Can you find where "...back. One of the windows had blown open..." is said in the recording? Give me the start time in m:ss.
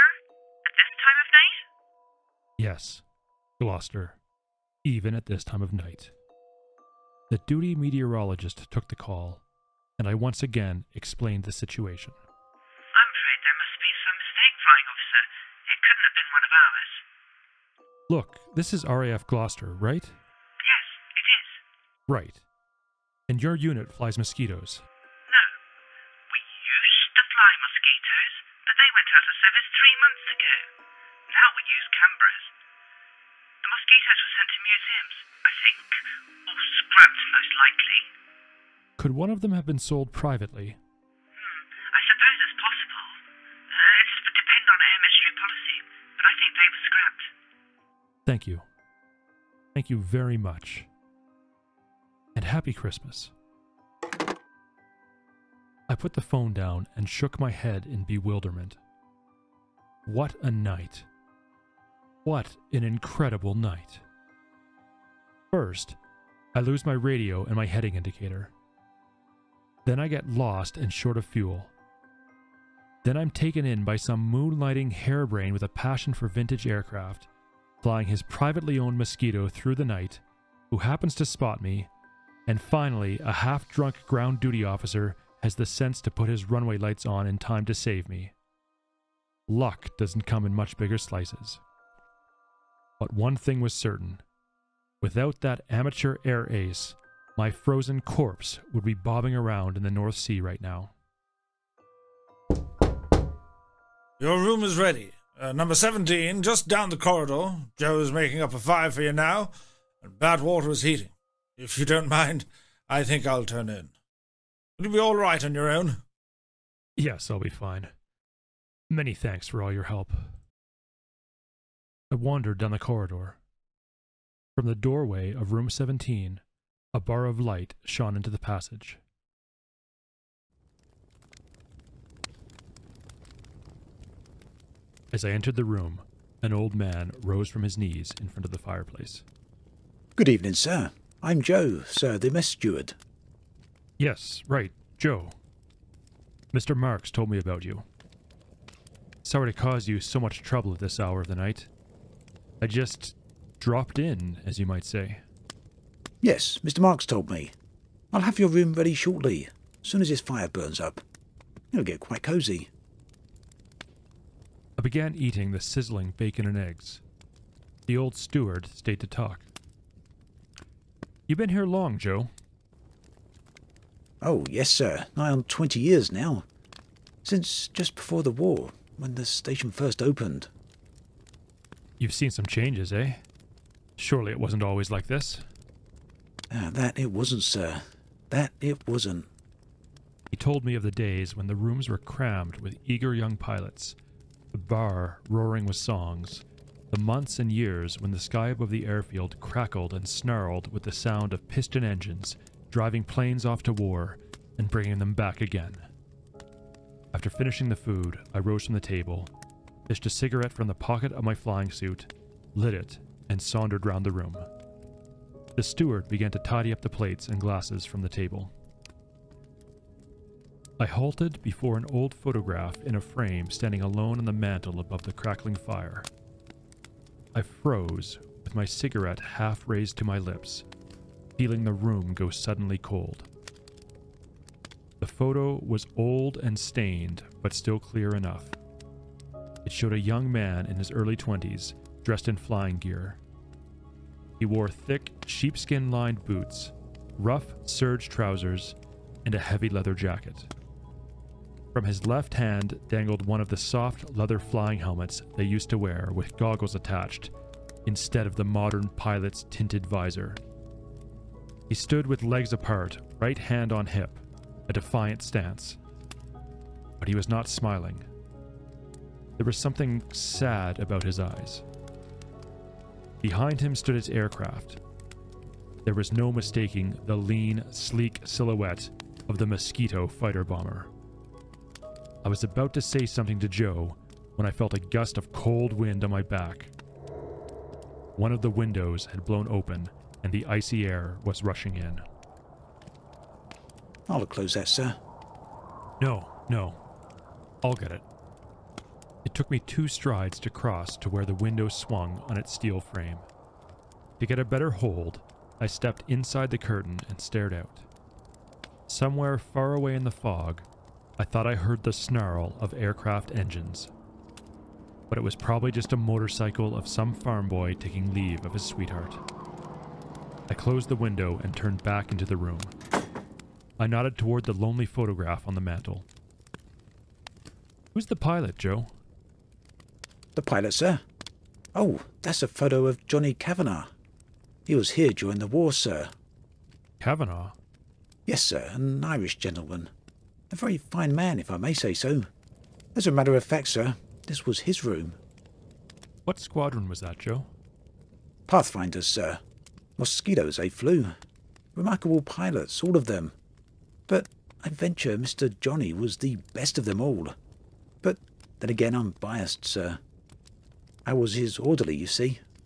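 4:46.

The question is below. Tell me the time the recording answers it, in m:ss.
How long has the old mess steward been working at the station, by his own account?
2:55.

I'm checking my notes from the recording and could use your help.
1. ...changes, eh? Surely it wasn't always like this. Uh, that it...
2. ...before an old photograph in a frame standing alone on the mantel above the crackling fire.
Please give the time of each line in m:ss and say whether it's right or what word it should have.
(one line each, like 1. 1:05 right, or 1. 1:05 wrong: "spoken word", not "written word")
1. 3:02 right
2. 3:41 right.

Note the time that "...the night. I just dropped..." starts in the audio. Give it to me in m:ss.
2:31.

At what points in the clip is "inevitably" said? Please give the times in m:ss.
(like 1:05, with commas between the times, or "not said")
not said.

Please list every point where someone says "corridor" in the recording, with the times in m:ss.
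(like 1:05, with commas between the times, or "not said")
1:46, 2:02.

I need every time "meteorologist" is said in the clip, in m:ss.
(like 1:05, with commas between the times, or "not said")
0:07.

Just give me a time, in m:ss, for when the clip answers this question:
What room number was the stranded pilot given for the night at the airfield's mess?
1:45.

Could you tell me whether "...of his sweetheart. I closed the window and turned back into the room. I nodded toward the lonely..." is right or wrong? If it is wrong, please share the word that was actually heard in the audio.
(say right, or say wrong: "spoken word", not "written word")
right.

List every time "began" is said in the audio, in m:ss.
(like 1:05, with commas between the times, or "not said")
2:44, 3:36.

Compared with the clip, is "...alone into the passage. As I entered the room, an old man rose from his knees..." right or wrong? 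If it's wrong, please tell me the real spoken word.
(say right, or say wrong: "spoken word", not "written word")
wrong: "shone", not "alone".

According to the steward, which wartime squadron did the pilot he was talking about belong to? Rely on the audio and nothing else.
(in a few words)
Pathfinders.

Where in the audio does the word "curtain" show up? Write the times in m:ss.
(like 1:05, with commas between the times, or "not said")
5:06.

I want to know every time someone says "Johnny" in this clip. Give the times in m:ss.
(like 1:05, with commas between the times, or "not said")
5:33, 5:55.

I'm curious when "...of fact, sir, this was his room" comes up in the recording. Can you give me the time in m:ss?
5:43.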